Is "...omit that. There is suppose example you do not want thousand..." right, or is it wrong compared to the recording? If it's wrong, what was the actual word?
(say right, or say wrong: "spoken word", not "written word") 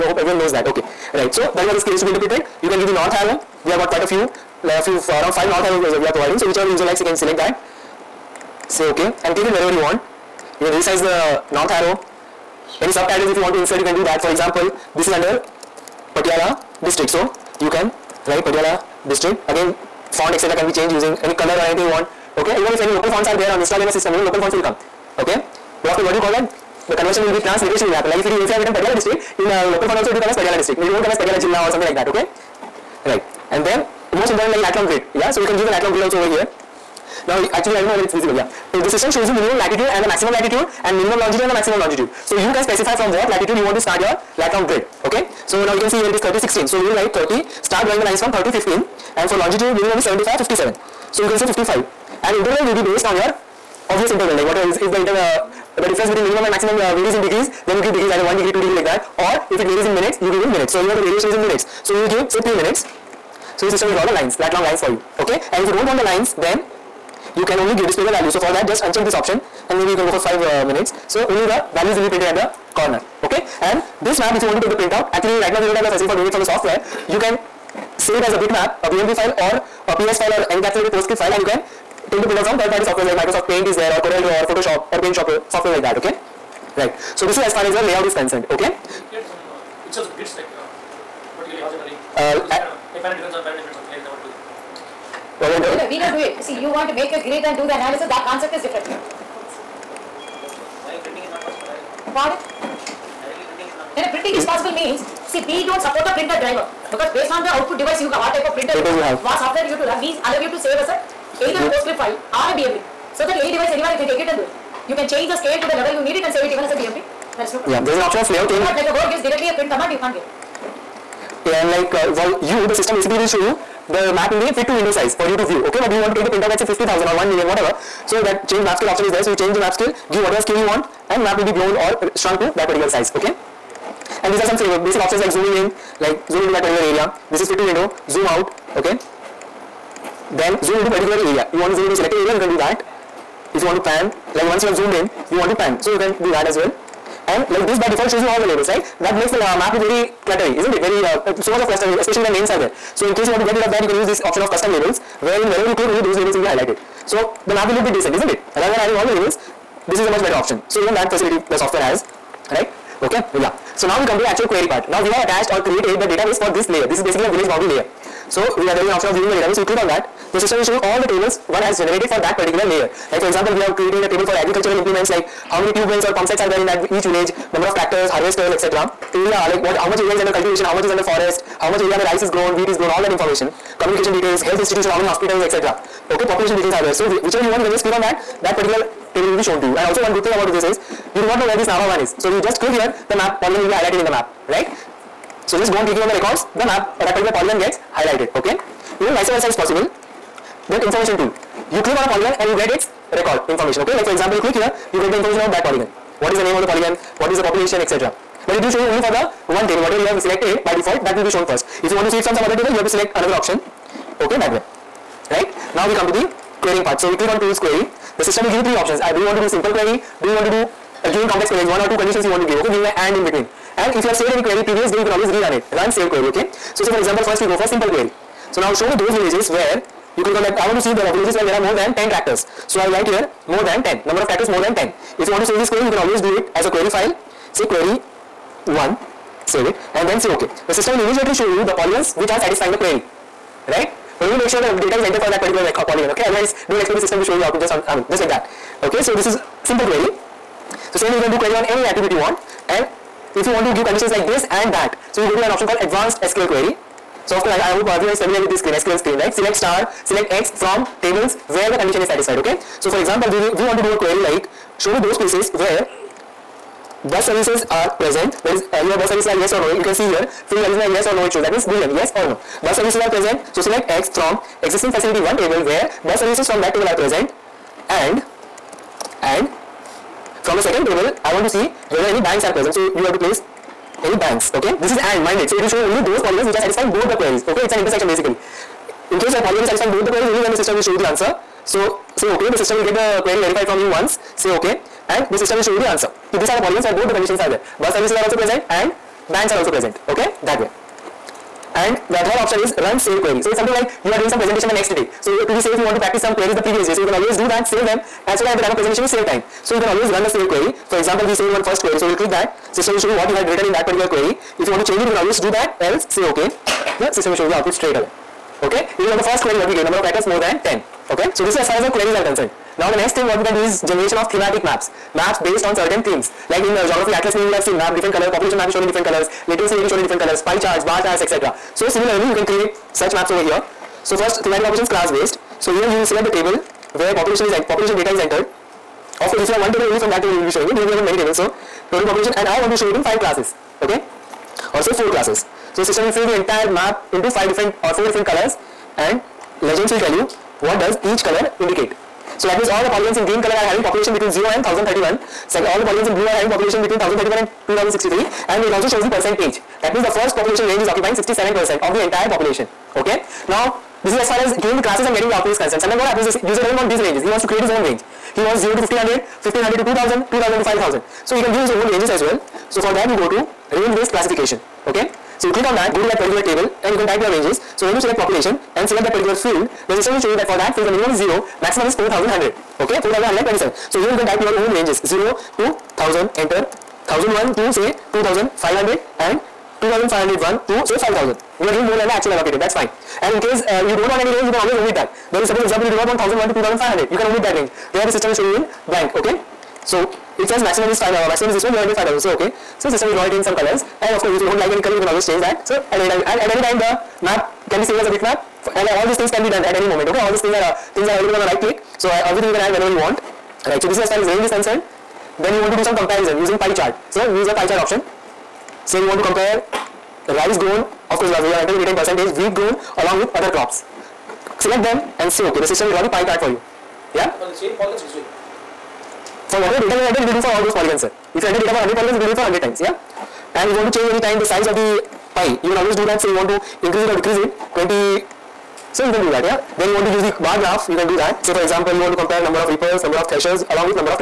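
right.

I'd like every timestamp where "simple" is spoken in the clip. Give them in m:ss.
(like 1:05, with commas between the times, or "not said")
3:39, 3:47, 4:09.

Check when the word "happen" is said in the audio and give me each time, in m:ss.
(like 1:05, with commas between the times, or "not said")
0:27, 6:06.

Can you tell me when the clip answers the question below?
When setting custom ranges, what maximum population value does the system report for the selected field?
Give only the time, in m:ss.
6:22.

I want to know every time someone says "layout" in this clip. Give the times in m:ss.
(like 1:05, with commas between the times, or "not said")
1:27, 1:58.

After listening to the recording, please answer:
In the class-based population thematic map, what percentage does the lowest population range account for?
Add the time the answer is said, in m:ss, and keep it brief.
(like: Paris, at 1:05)
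67%, at 6:01.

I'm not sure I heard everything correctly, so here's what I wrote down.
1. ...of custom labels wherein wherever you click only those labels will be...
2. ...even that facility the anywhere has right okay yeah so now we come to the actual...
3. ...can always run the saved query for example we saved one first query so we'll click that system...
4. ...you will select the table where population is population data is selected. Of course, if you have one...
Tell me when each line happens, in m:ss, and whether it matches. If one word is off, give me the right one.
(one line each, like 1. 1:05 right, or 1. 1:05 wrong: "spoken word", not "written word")
1. 2:34 right
2. 2:40 wrong: "software", not "anywhere"
3. 5:09 right
4. 5:35 wrong: "entered", not "selected".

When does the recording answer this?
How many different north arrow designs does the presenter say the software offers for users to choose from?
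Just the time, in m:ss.
0:05.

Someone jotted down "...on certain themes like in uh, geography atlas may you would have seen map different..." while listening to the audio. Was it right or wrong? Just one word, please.
right.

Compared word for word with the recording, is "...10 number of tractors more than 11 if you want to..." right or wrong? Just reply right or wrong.
wrong.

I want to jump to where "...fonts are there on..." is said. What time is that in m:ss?
0:23.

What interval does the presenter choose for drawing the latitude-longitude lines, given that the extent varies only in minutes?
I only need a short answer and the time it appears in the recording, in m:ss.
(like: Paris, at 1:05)
3 minutes, at 1:02.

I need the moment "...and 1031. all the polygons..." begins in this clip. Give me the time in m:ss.
5:54.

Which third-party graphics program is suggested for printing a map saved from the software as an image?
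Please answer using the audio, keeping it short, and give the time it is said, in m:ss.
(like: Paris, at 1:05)
CorelDRAW, at 1:24.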